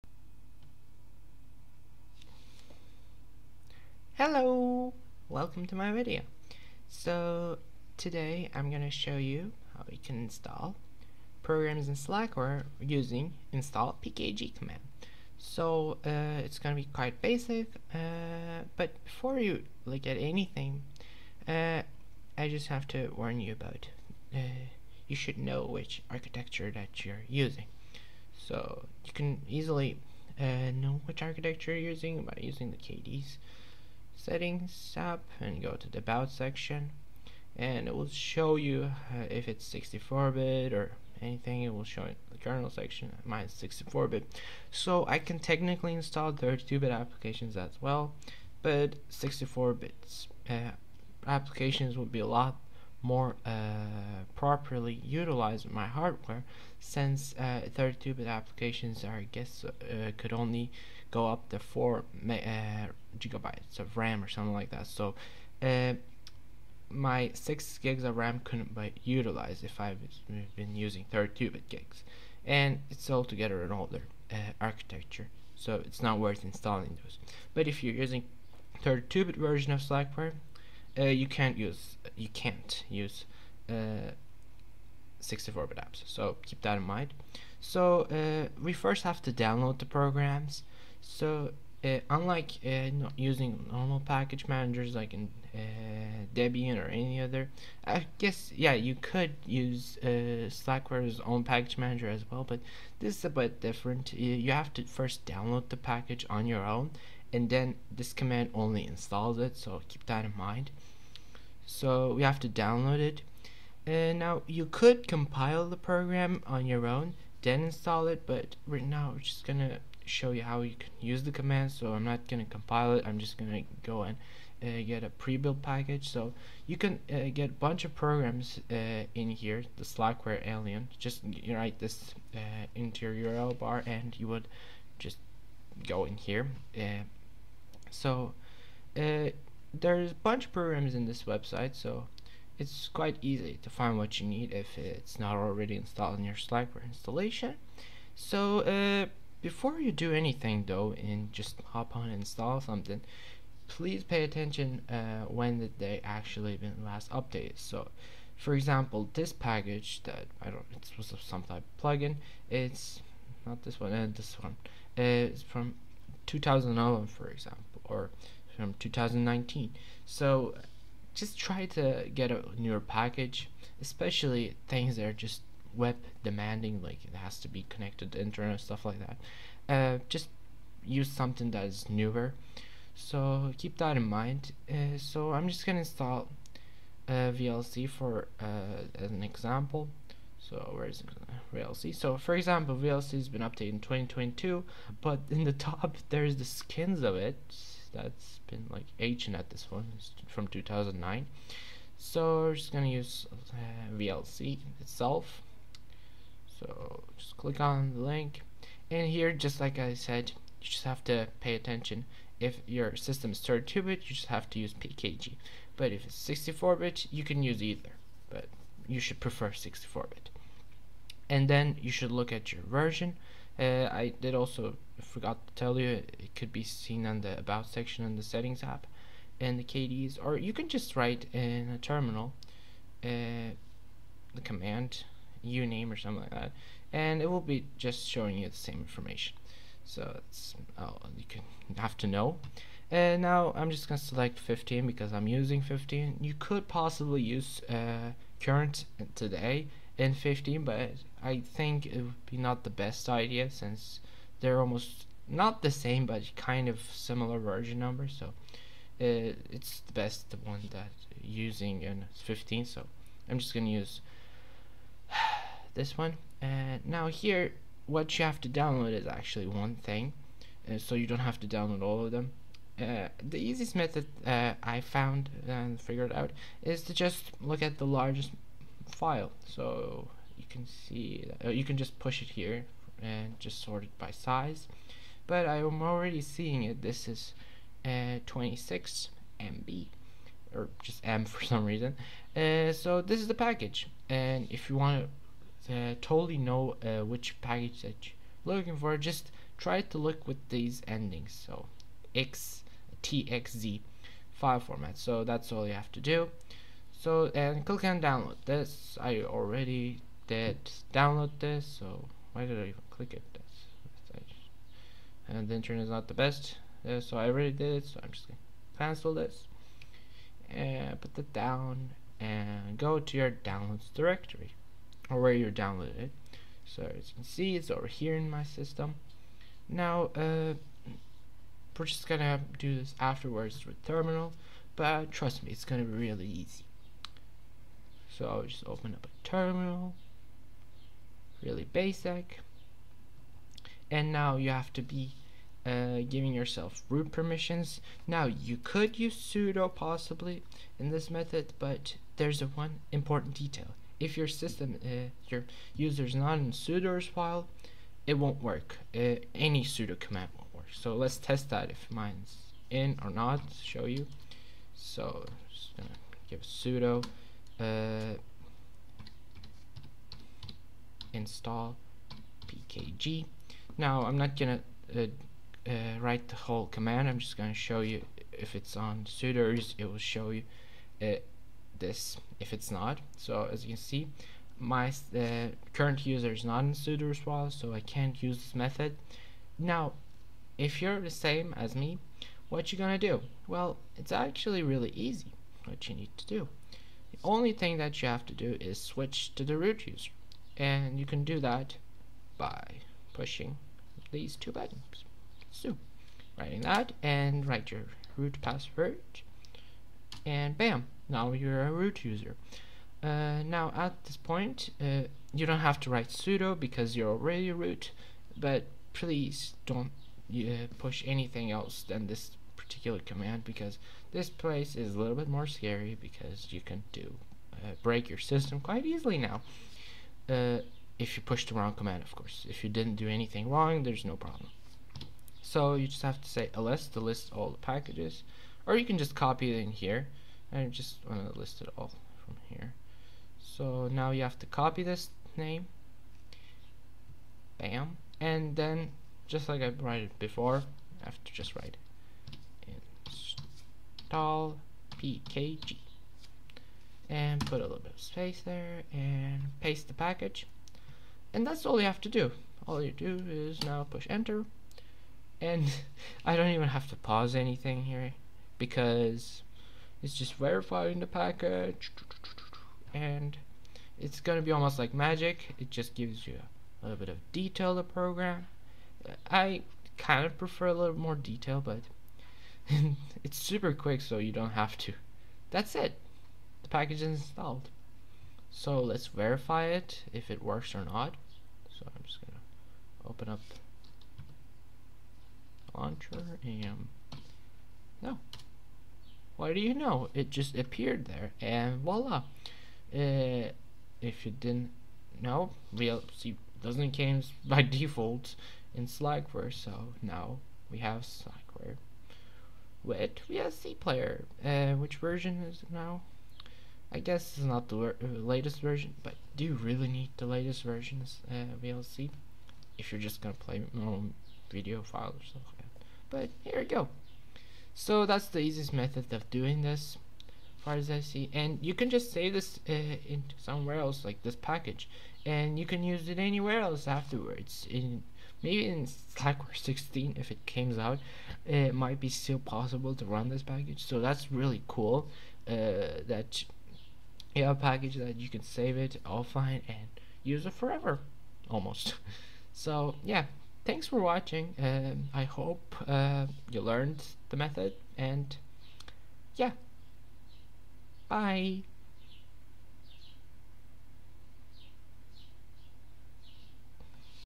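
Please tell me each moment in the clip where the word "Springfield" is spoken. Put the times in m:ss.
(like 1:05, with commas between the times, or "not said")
not said.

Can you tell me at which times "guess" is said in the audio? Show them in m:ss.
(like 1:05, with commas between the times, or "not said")
0:59, 1:38, 8:36.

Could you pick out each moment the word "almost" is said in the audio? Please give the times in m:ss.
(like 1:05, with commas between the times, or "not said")
4:14, 7:54, 9:11.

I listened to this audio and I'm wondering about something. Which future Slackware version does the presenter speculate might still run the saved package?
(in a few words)
Slackware 16.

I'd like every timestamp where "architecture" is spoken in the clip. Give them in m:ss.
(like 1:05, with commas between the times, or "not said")
0:26, 0:31, 1:14.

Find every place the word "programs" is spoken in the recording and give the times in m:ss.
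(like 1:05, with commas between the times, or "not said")
0:11, 1:29, 1:55, 2:07, 2:20, 7:57.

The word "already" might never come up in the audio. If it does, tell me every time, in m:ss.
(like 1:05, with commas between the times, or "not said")
2:25, 4:45, 5:09, 5:17, 6:57.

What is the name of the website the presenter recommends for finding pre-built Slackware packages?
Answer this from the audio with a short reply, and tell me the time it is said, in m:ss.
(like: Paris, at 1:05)
slackware alien, at 2:09.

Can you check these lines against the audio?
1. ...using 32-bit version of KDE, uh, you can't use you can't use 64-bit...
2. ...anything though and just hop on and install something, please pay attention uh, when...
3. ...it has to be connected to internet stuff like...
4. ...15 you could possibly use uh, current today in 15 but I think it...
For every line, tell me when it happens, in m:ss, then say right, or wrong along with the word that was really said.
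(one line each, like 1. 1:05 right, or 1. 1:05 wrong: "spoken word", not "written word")
1. 1:17 wrong: "Slackware", not "KDE"
2. 2:30 right
3. 2:57 right
4. 4:05 right.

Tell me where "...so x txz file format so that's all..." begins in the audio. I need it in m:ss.
5:01.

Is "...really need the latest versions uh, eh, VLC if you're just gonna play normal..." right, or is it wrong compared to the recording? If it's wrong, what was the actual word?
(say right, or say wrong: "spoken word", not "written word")
right.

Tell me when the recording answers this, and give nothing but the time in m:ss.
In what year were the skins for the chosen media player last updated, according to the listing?
3:20.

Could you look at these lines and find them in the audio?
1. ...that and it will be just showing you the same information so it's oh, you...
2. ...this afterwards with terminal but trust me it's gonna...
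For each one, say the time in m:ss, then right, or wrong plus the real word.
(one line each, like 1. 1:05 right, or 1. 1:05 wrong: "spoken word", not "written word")
1. 3:56 right
2. 5:32 right.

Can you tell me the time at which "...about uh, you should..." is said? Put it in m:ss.
0:23.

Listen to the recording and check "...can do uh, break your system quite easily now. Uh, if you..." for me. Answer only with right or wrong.
right.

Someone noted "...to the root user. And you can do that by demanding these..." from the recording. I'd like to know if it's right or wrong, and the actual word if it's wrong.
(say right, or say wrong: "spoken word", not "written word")
wrong: "pushing", not "demanding".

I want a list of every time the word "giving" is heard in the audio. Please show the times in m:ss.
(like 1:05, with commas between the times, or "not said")
5:46.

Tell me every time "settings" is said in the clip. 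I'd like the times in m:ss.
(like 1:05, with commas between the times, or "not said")
0:34, 3:48.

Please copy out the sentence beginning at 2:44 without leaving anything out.
it's from 2011 for example or from 2019.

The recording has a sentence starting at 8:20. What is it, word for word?
It just appeared there and voila.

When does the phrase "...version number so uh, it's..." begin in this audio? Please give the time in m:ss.
4:17.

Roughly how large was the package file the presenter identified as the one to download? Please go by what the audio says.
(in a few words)
26 MB.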